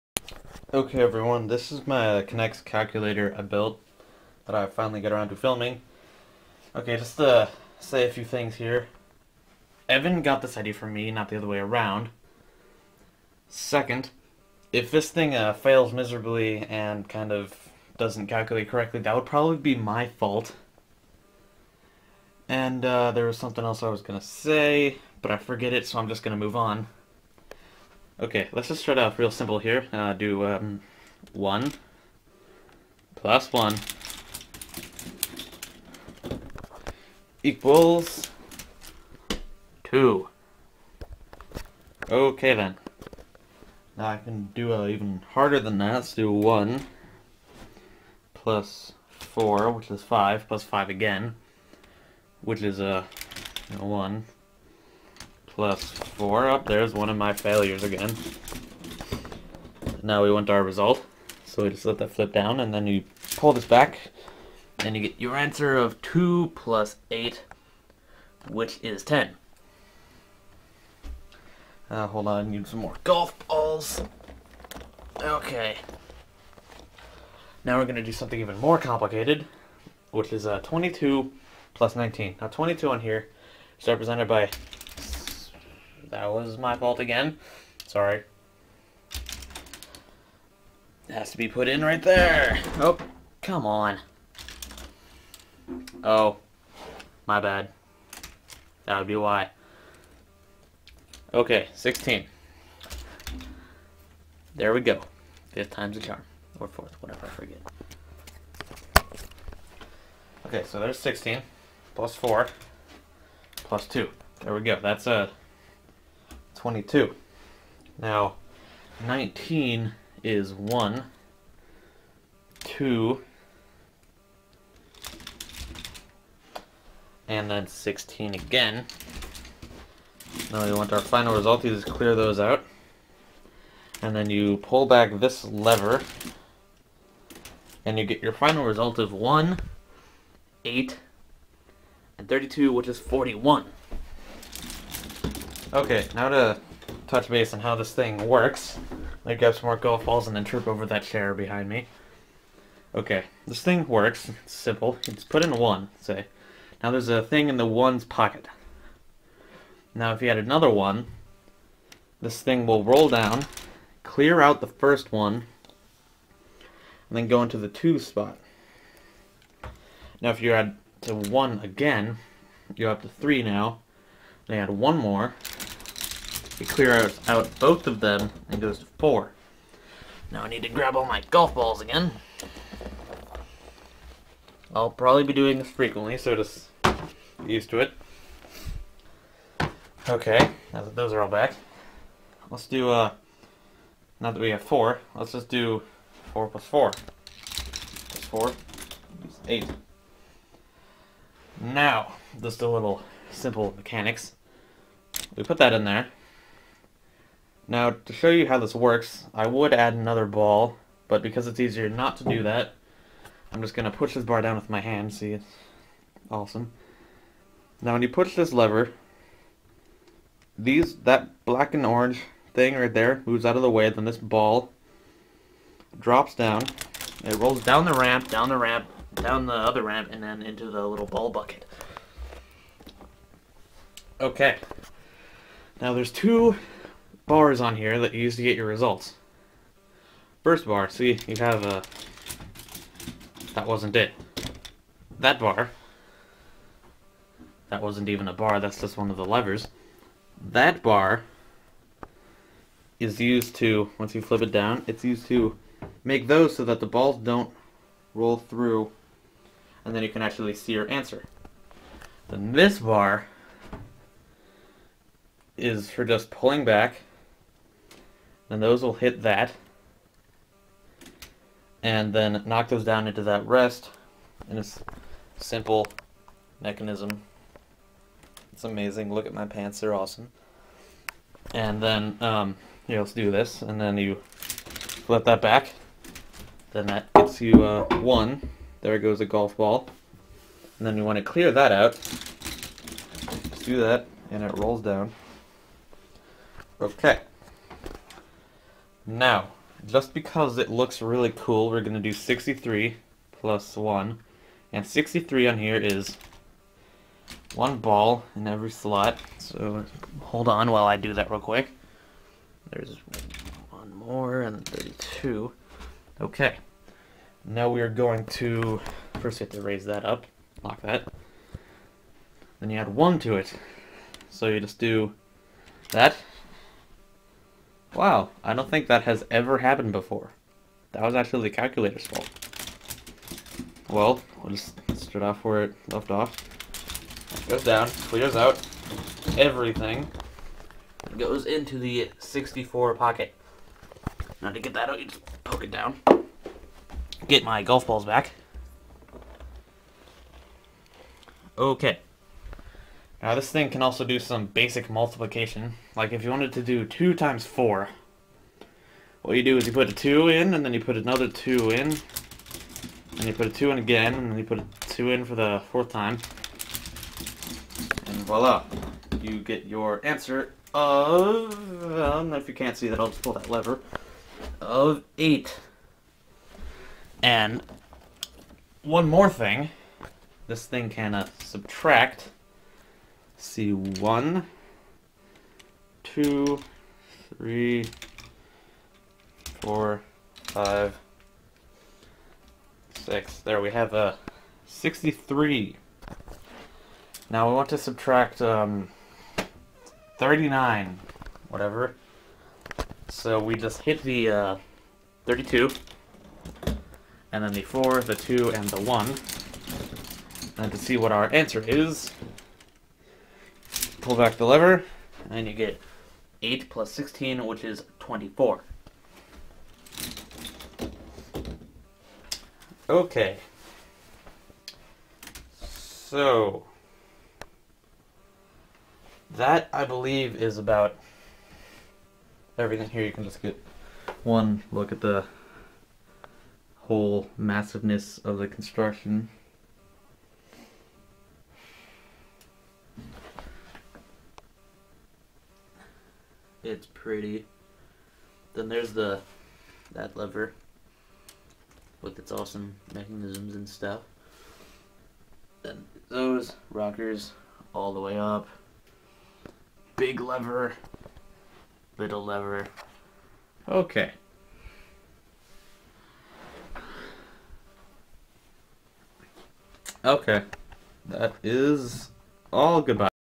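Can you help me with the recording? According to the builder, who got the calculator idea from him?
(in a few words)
Evan.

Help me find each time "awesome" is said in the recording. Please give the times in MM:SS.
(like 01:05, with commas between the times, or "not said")
03:36, 04:39, 07:32.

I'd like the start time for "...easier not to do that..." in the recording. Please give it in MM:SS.
03:31.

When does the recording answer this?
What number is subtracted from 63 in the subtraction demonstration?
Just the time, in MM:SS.
06:40.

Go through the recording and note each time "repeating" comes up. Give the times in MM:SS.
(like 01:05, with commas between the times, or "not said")
not said.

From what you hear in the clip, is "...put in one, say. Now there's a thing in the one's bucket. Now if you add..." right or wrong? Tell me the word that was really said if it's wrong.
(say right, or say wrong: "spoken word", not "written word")
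wrong: "pocket", not "bucket".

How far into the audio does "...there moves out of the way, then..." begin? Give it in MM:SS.
03:42.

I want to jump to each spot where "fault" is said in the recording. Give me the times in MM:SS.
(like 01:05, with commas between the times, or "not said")
00:20, 01:26, 05:32.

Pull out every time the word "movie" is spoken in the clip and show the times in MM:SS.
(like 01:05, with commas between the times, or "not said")
not said.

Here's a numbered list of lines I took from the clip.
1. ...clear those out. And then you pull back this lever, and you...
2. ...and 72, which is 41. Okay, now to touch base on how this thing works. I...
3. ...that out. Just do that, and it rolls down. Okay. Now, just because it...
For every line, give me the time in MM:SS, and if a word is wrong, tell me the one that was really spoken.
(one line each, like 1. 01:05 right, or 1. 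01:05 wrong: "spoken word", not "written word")
1. 02:11 right
2. 02:22 wrong: "32", not "72"
3. 04:51 right.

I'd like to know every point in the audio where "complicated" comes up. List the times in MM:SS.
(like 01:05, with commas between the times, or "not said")
01:18.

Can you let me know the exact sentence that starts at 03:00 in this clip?
Now I need to grab all my golf balls again.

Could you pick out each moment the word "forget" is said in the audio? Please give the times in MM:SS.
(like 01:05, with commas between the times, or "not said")
00:25, 01:47.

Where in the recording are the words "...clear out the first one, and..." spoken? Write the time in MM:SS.
02:44.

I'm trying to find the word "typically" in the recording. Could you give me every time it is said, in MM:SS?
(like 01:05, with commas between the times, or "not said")
not said.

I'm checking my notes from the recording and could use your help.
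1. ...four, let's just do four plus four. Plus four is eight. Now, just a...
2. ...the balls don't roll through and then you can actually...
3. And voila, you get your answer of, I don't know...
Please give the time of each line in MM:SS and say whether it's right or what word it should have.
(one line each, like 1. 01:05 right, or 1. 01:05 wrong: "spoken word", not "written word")
1. 03:14 right
2. 04:16 right
3. 06:08 right.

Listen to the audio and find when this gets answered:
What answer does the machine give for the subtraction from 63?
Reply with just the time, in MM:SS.
06:57.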